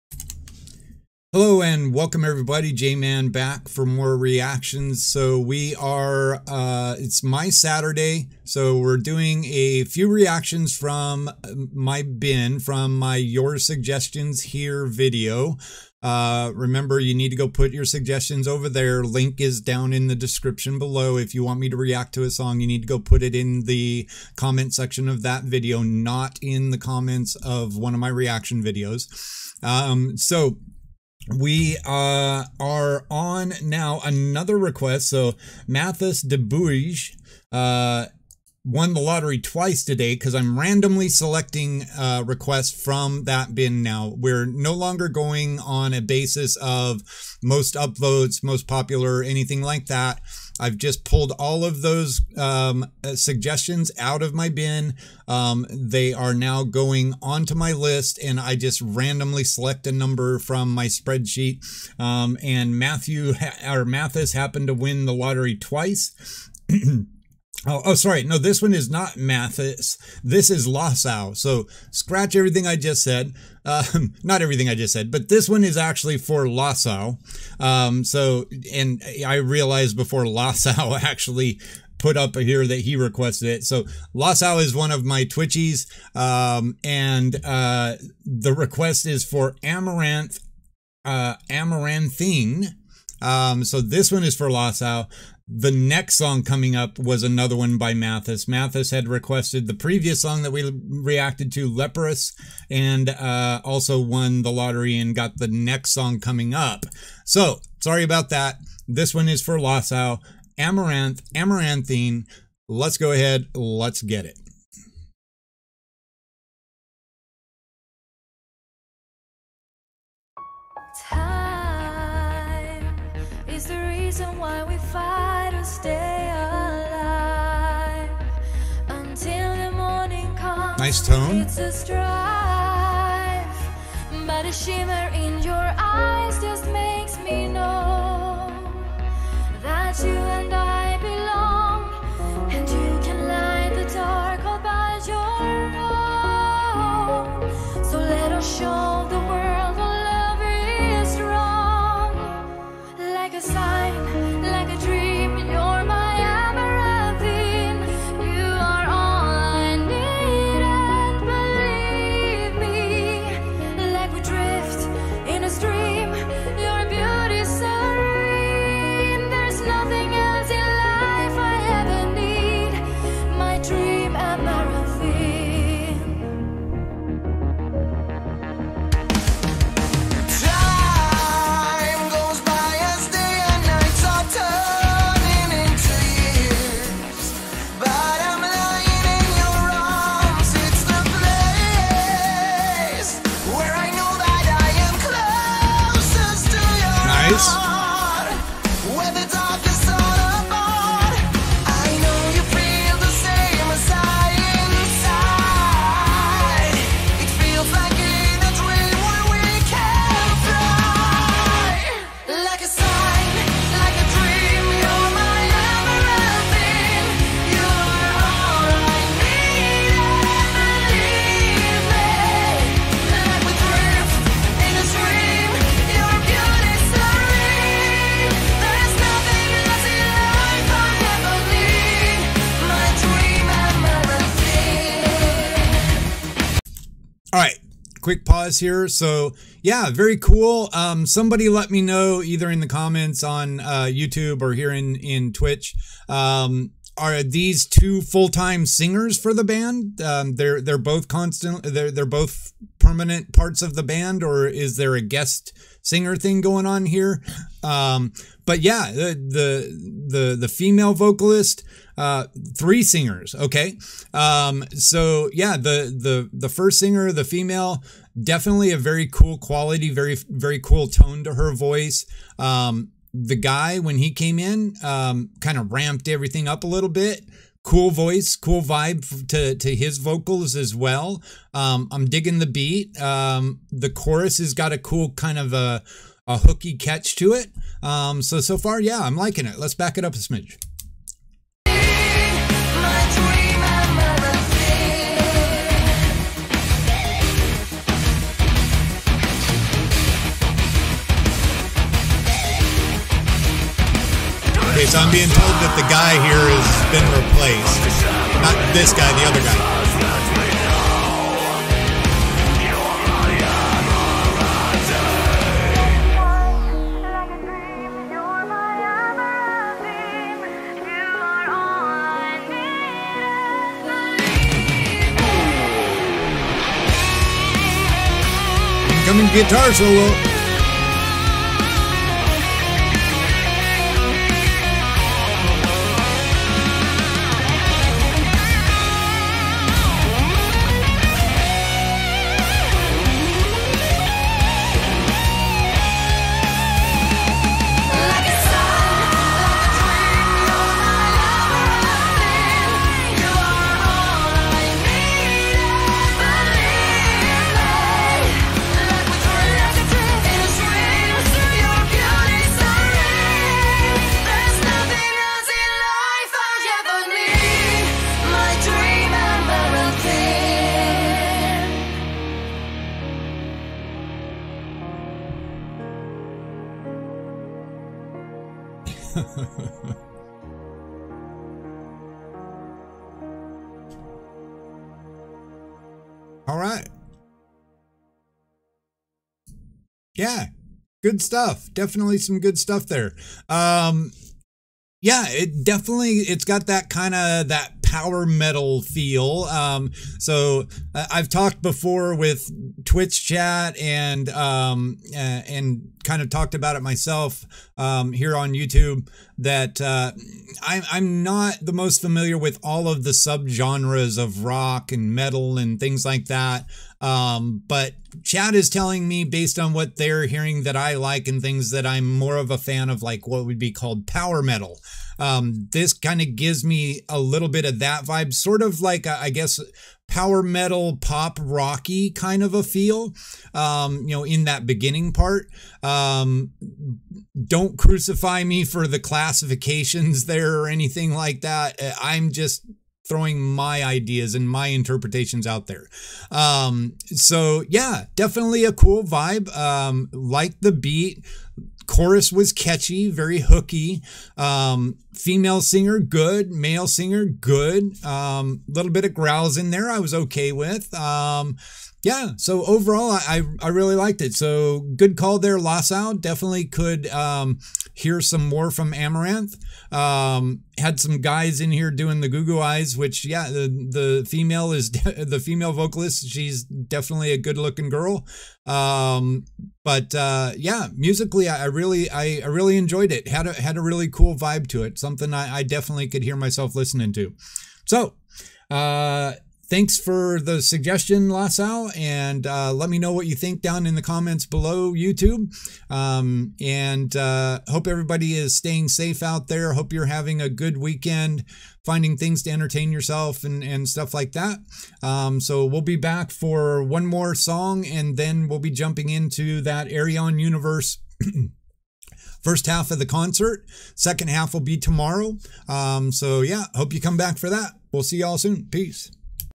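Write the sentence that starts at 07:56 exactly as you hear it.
She's definitely a good looking girl.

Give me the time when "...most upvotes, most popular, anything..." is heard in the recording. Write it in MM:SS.
00:47.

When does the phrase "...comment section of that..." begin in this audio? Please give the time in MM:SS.
00:24.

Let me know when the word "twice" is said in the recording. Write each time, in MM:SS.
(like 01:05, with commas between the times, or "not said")
00:39, 01:05.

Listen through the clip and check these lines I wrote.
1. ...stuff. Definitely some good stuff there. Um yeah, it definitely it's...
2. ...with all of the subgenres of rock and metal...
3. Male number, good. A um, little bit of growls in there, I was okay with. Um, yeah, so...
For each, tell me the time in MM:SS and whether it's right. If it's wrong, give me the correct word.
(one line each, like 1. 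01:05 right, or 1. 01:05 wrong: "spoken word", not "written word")
1. 06:31 right
2. 06:52 right
3. 07:36 wrong: "singer", not "number".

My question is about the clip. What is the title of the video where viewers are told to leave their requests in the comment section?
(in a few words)
Your Suggestions Here.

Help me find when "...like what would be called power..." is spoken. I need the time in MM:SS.
07:03.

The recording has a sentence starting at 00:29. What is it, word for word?
Um, so we uh, are on now another request.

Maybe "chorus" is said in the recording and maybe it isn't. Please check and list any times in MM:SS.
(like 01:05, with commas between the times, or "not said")
04:43, 07:31.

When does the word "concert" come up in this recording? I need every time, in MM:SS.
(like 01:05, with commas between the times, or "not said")
08:33.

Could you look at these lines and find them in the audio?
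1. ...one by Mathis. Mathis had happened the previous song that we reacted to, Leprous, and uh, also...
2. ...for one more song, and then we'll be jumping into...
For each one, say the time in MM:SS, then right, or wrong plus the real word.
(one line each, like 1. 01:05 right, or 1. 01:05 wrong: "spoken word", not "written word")
1. 01:37 wrong: "requested", not "happened"
2. 08:26 right.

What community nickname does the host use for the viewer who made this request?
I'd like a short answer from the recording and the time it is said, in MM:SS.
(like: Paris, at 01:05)
Twitchies, at 01:25.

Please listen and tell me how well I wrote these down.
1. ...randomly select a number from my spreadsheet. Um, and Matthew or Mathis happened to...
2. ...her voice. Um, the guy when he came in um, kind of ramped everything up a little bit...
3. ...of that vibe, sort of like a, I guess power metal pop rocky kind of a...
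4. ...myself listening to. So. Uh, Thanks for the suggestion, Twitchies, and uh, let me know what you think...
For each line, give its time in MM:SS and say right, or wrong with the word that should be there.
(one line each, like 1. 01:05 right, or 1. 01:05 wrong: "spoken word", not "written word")
1. 00:58 right
2. 04:31 right
3. 07:07 right
4. 08:06 wrong: "Lassau", not "Twitchies".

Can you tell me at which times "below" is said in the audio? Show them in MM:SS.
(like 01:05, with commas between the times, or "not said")
00:20, 08:14.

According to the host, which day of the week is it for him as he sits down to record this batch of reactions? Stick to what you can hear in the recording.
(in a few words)
Saturday.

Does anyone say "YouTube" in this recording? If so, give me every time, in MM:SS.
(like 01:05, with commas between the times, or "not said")
04:03, 06:48, 08:14.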